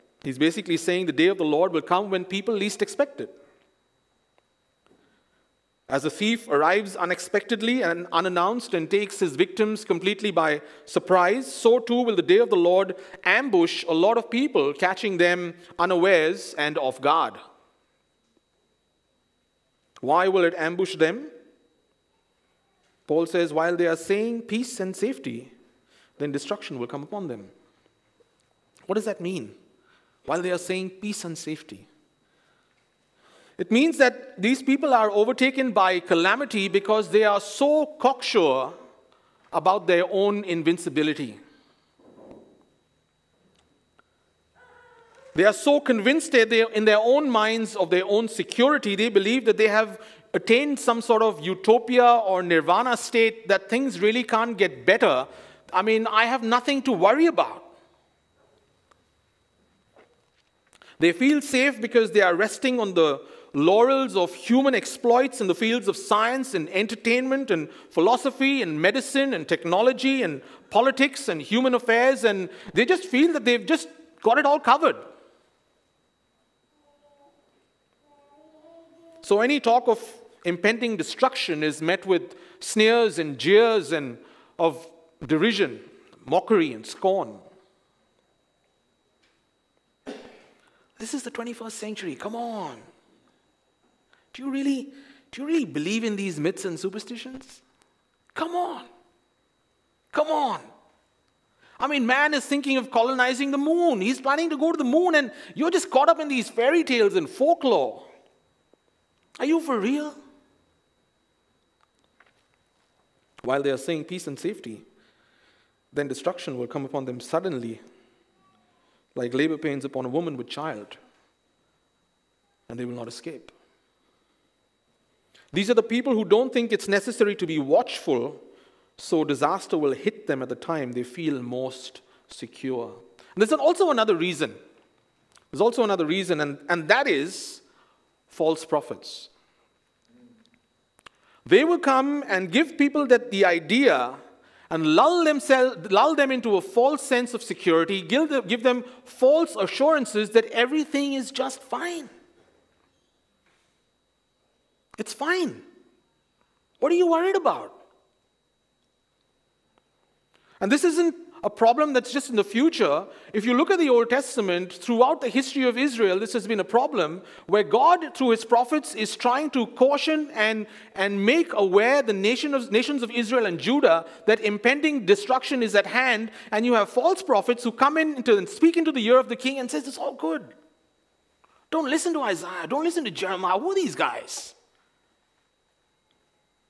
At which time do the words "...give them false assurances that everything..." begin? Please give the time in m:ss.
2:28.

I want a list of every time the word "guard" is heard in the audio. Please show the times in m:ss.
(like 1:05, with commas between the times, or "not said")
0:17.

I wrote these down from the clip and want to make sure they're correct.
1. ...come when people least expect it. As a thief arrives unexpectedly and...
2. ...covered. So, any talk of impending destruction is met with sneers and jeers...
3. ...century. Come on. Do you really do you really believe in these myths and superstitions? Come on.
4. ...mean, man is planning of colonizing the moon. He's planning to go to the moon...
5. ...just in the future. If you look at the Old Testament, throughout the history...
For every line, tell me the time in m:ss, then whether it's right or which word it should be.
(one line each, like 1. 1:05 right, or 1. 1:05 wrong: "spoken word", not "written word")
1. 0:01 right
2. 1:14 right
3. 1:31 right
4. 1:41 wrong: "thinking", not "planning"
5. 2:42 right.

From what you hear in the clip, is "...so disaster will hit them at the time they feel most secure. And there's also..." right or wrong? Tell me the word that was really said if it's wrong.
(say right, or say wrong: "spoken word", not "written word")
right.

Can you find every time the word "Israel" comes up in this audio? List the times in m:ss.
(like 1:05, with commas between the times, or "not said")
2:45, 2:53.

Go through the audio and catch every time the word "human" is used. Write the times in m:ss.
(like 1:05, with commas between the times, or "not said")
1:04, 1:11.